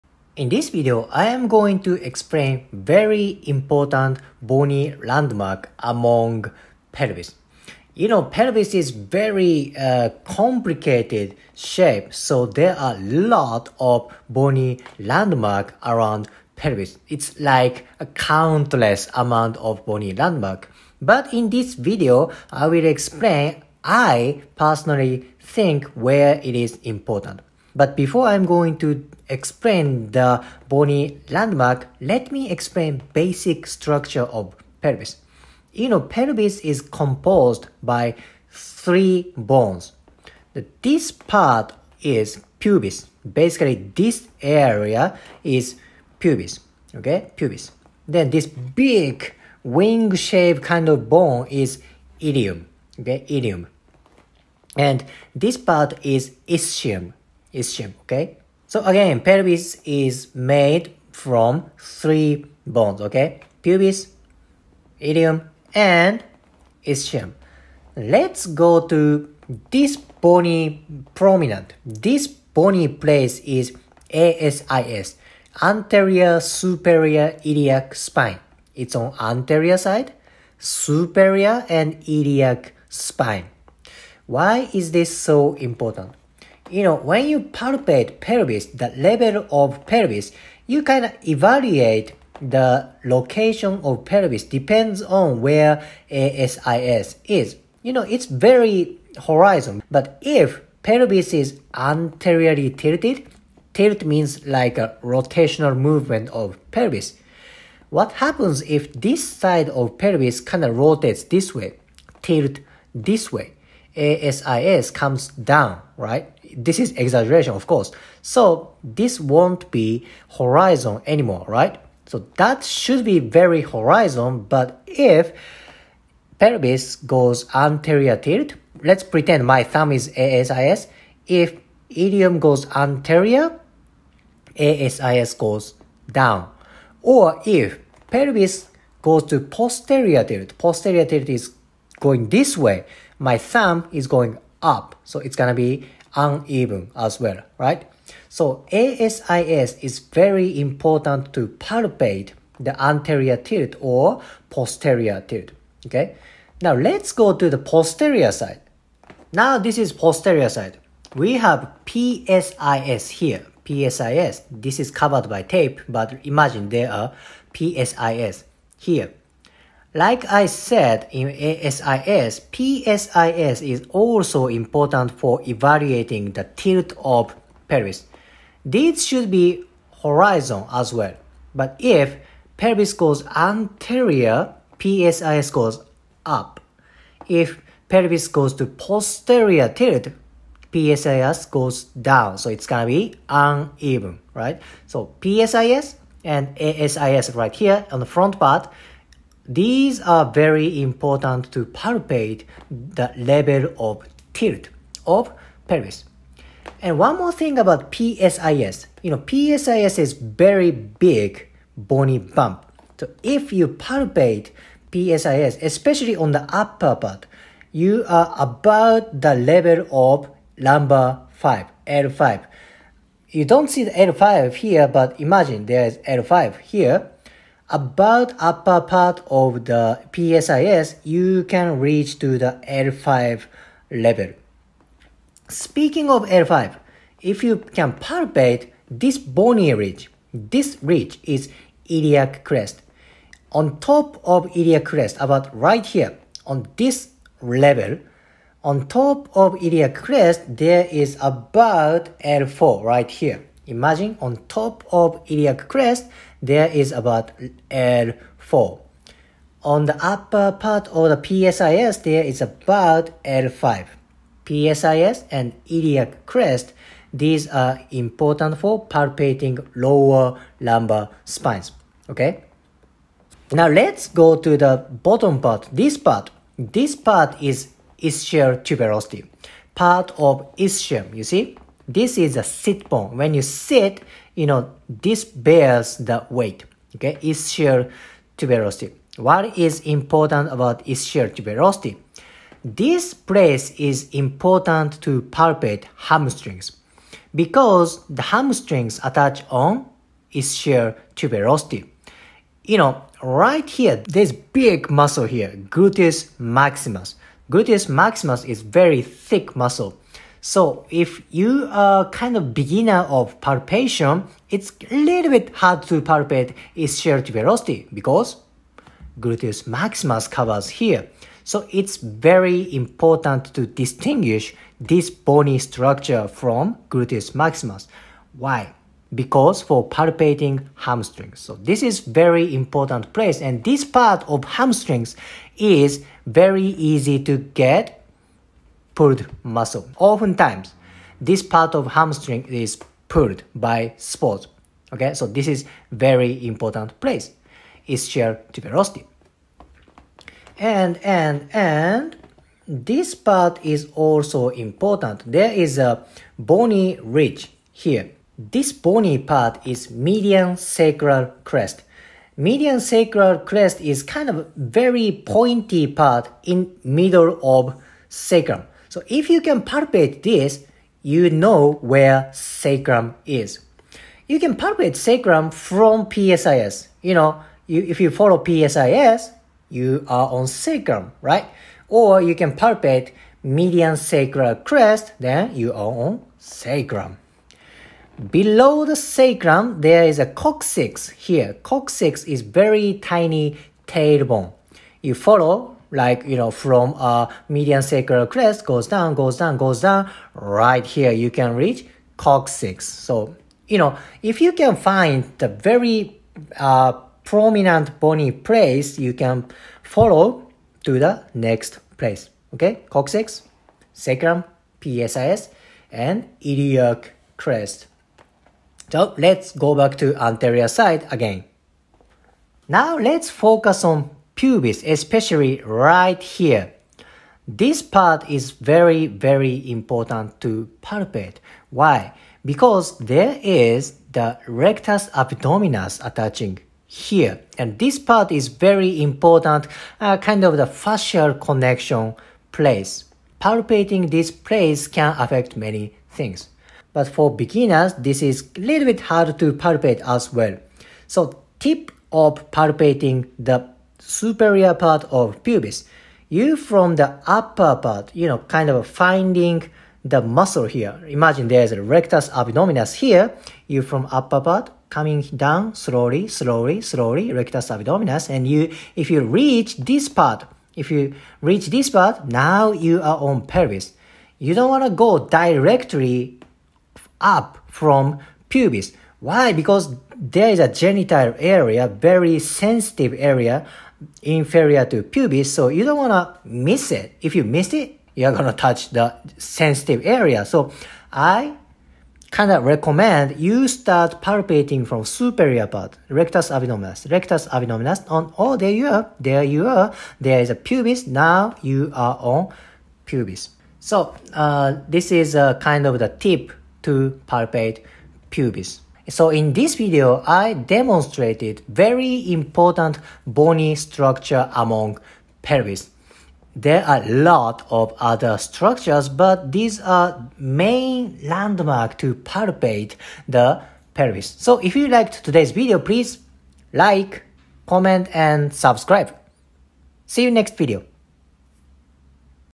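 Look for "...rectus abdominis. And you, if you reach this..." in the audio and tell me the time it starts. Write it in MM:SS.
07:47.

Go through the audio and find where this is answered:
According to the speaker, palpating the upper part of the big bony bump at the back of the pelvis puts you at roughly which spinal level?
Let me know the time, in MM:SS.
03:40.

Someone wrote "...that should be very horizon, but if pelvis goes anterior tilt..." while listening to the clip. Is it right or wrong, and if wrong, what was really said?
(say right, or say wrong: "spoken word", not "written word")
right.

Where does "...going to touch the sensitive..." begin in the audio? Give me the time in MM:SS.
08:08.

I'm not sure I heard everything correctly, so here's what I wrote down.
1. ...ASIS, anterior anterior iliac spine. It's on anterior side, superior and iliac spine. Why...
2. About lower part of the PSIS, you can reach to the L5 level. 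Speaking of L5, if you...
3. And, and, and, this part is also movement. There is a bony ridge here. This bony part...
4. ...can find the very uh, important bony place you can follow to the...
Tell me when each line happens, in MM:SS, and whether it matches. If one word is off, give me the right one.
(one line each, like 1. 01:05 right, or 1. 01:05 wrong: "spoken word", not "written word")
1. 01:14 wrong: "superior", not "anterior"
2. 03:47 wrong: "upper", not "lower"
3. 05:50 wrong: "important", not "movement"
4. 06:44 wrong: "prominent", not "important".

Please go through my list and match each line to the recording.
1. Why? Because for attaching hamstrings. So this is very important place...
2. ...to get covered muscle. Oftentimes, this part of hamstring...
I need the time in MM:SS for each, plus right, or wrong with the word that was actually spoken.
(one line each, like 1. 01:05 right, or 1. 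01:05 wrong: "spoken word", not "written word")
1. 05:28 wrong: "palpating", not "attaching"
2. 05:37 wrong: "pulled", not "covered".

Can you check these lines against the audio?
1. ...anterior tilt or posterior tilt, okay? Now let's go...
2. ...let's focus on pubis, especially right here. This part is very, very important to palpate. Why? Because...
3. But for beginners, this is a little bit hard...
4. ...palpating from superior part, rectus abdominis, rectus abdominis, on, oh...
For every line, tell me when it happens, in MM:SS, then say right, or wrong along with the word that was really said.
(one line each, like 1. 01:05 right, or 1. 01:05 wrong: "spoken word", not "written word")
1. 02:32 right
2. 07:02 right
3. 07:26 right
4. 08:14 right.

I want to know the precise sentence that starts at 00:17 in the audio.
It's like a countless amount of bony landmark.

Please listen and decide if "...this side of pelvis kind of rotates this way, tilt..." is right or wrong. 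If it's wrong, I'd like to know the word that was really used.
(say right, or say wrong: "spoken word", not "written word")
right.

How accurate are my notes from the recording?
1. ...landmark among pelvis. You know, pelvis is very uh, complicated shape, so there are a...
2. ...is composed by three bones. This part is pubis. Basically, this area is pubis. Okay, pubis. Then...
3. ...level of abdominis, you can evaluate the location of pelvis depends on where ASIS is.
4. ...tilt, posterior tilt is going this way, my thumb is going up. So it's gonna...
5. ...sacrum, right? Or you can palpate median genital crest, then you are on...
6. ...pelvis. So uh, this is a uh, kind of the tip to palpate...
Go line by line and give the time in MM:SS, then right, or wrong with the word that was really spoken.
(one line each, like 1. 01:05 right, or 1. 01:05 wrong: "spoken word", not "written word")
1. 00:04 right
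2. 00:36 right
3. 01:28 wrong: "pelvis", not "abdominis"
4. 02:20 right
5. 06:20 wrong: "sacral", not "genital"
6. 08:23 wrong: "pubis", not "pelvis".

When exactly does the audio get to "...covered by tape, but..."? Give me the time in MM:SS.
02:44.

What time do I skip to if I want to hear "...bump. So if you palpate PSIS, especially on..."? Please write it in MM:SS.
03:32.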